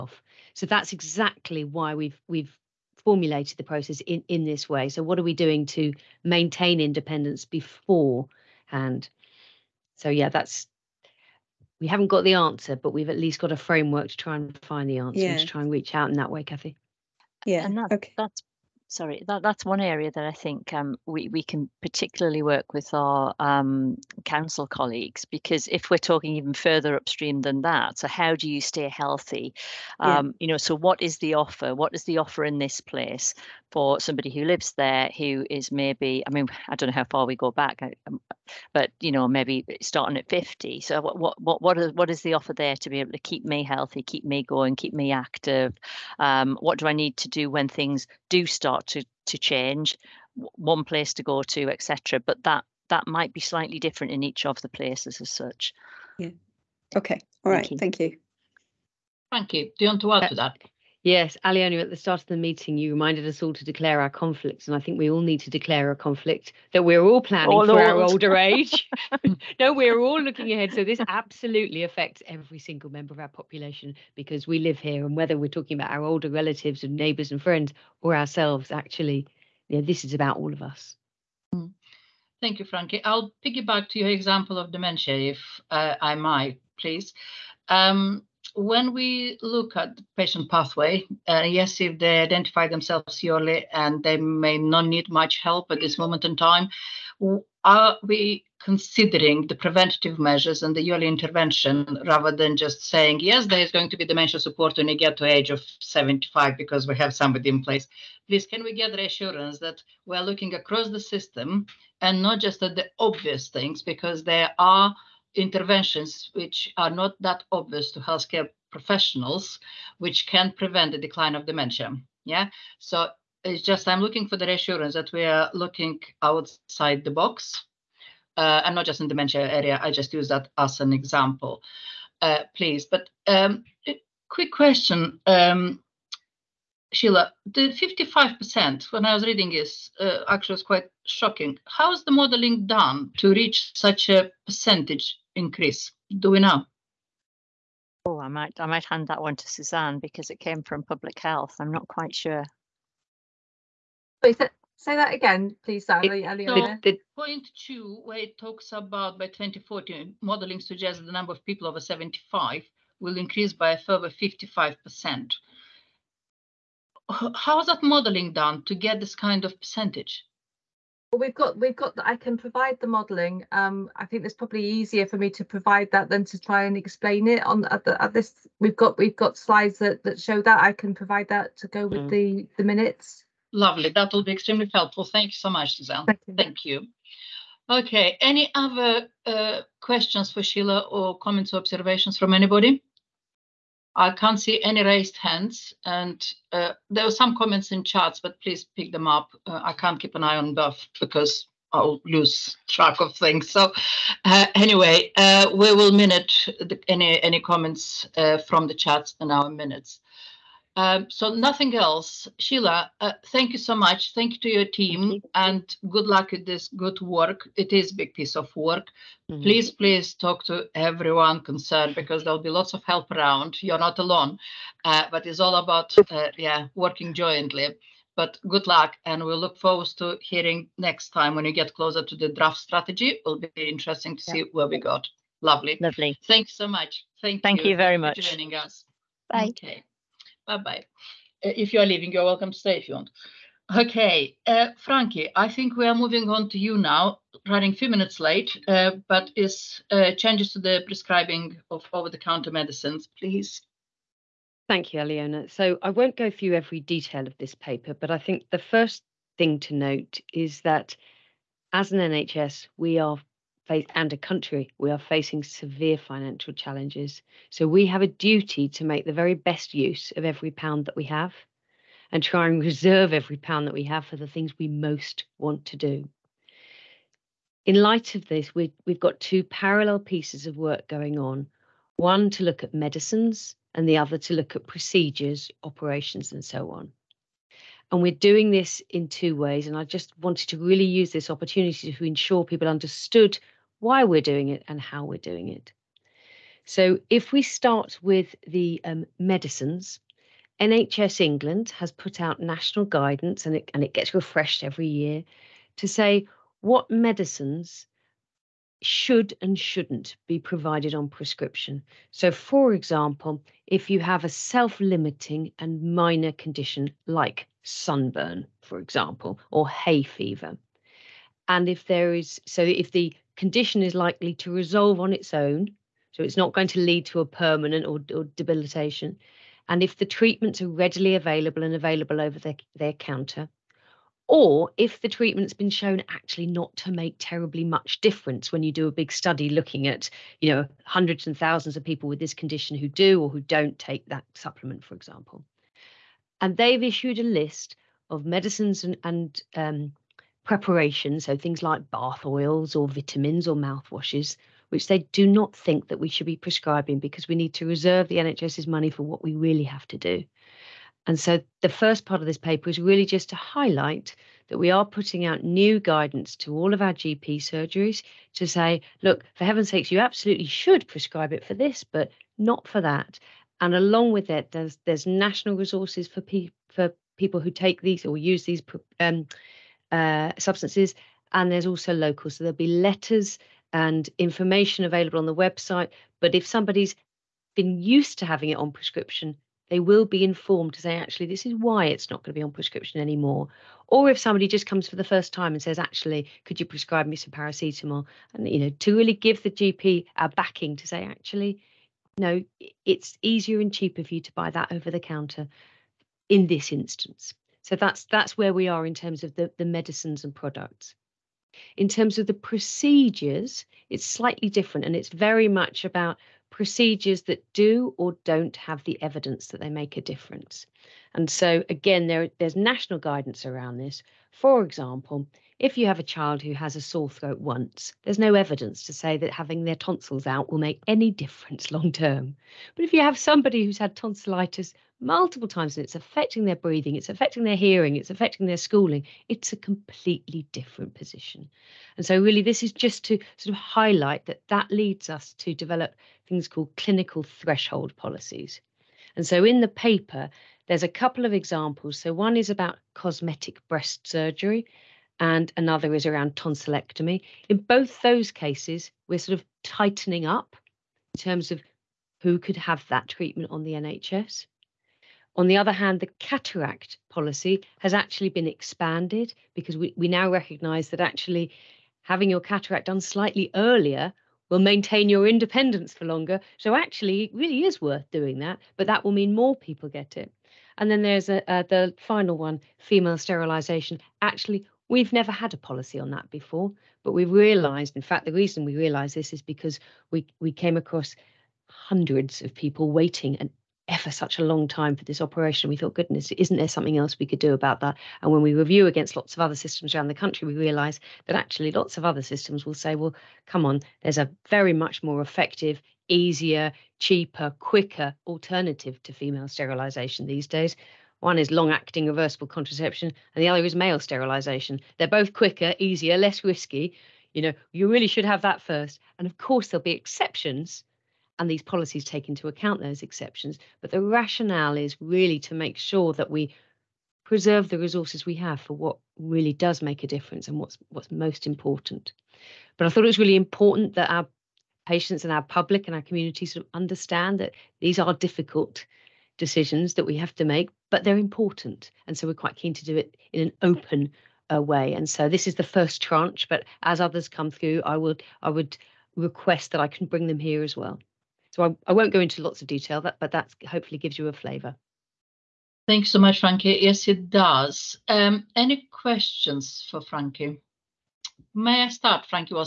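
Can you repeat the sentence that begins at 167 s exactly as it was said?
How is that modeling done to get this kind of percentage?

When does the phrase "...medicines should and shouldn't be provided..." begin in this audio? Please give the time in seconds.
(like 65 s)
306 s.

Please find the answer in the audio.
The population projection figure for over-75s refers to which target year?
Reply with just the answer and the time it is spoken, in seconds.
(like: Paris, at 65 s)
2040, at 159 s.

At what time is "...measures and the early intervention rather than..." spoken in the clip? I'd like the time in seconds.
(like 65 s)
100 s.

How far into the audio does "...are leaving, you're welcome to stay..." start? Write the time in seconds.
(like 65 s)
241 s.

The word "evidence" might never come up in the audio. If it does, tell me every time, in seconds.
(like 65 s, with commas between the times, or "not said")
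419 s, 428 s.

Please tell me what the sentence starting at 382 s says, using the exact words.
So there'll be letters and information available on the website.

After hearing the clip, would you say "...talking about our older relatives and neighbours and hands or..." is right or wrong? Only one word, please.
wrong.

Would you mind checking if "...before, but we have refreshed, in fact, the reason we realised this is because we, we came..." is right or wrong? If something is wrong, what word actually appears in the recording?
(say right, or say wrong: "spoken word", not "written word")
wrong: "realised", not "refreshed".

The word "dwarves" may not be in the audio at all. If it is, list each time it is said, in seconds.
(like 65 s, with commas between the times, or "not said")
not said.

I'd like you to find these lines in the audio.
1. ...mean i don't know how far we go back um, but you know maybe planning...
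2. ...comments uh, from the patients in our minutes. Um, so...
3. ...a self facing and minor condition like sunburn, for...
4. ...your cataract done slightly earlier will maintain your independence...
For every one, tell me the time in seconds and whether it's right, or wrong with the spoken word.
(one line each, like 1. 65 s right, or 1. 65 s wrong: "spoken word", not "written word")
1. 36 s wrong: "starting", not "planning"
2. 207 s wrong: "chats", not "patients"
3. 314 s wrong: "limiting", not "facing"
4. 472 s right.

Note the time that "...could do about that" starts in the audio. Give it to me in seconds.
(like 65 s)
497 s.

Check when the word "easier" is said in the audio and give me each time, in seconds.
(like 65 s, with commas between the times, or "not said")
174 s, 403 s, 506 s, 515 s.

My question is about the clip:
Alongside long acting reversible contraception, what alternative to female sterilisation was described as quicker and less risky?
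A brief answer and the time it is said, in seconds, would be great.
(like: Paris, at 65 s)
male sterilization, at 513 s.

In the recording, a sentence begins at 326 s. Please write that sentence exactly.
So it's not going to lead to a permanent or, or debilitation.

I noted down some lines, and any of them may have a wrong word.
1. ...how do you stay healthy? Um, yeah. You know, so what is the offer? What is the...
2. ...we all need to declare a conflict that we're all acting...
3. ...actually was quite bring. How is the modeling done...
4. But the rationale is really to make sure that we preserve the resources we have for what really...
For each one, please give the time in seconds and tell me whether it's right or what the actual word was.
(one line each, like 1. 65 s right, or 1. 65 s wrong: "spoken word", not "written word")
1. 28 s right
2. 64 s wrong: "planning", not "acting"
3. 140 s wrong: "shocking", not "bring"
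4. 523 s right.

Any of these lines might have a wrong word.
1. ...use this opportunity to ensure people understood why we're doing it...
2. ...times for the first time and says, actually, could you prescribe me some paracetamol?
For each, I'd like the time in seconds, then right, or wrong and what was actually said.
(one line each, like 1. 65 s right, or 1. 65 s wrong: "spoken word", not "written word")
1. 290 s right
2. 394 s wrong: "comes", not "times".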